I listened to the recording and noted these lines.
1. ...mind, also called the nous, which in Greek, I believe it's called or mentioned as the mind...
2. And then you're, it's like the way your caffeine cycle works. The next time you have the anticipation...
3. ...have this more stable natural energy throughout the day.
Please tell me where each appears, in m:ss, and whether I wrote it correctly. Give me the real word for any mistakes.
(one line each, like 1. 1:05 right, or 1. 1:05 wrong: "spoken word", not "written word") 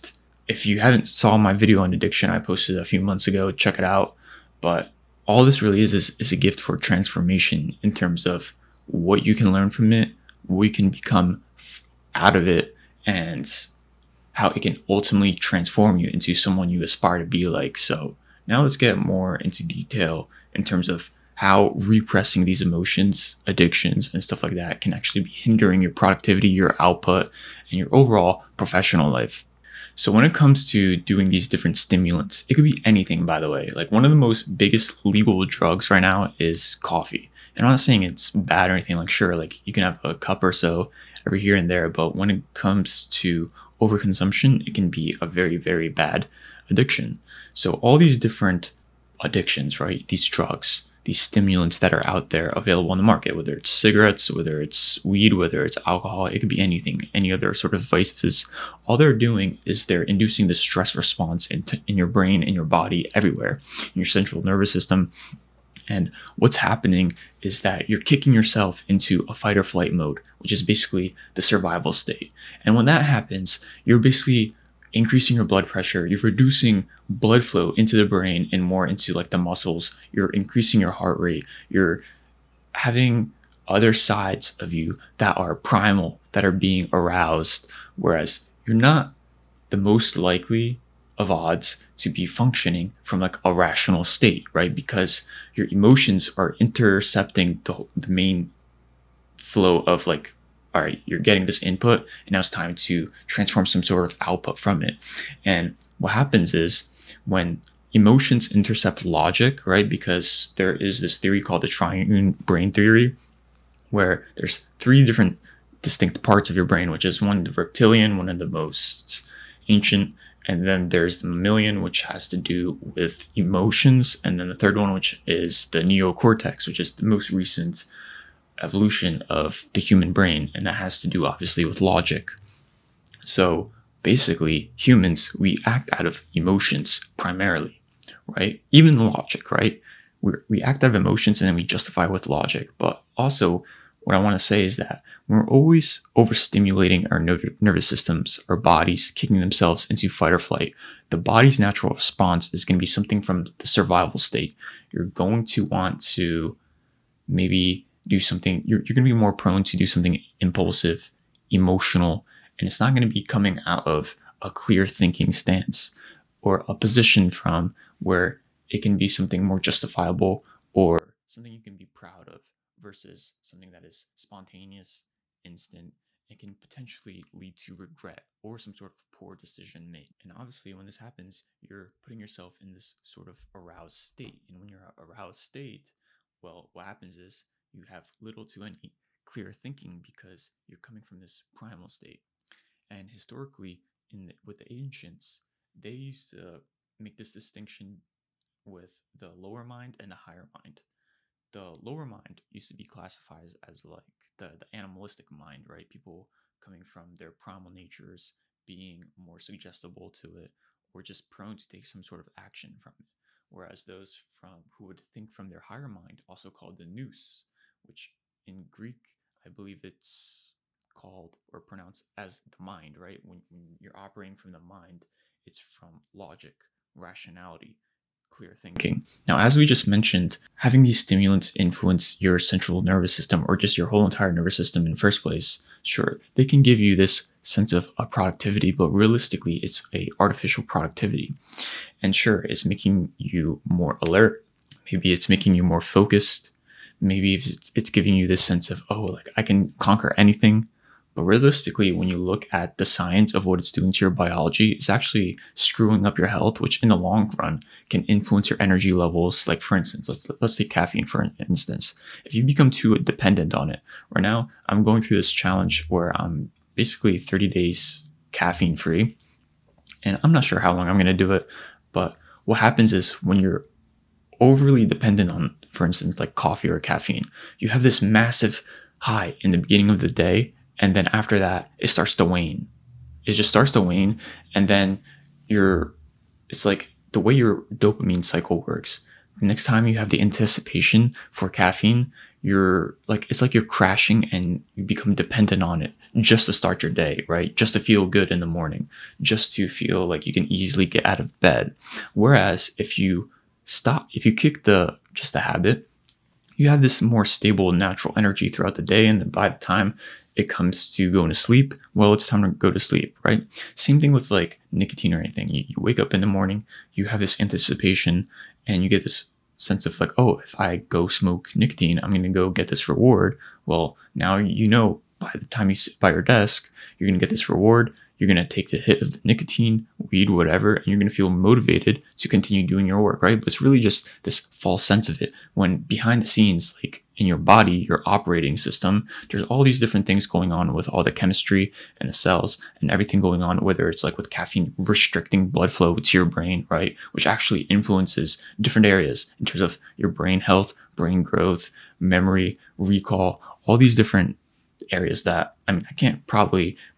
1. 3:35 wrong: "pronounced", not "mentioned"
2. 4:44 wrong: "dopamine", not "caffeine"
3. 5:06 right.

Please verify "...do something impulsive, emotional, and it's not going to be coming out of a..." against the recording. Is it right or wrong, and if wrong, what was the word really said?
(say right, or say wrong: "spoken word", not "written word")
right.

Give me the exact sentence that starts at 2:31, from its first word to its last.
The body's natural response is going to be something from the survival state.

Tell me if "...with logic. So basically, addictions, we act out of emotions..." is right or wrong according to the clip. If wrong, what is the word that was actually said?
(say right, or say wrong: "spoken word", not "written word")
wrong: "humans", not "addictions".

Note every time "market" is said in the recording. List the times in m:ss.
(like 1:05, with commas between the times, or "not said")
0:53.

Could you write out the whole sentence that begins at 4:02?
And sure, it's making you more alert.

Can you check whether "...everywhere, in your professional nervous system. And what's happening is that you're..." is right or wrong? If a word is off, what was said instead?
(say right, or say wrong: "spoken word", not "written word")
wrong: "central", not "professional".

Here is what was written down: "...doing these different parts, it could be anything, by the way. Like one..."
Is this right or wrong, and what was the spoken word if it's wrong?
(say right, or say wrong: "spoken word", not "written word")
wrong: "stimulants", not "parts".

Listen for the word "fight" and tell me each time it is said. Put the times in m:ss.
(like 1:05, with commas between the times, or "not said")
1:09, 2:30.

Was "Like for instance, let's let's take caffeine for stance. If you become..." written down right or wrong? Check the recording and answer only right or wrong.
wrong.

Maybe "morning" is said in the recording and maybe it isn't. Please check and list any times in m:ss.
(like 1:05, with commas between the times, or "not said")
4:58, 5:16.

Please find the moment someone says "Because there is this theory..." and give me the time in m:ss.
1:49.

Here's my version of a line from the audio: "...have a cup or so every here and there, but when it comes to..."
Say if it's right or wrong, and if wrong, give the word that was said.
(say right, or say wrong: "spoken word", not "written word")
right.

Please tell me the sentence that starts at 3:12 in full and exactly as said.
And historically, in the, with the ancients, they used to make this distinction with the lower mind and the higher mind.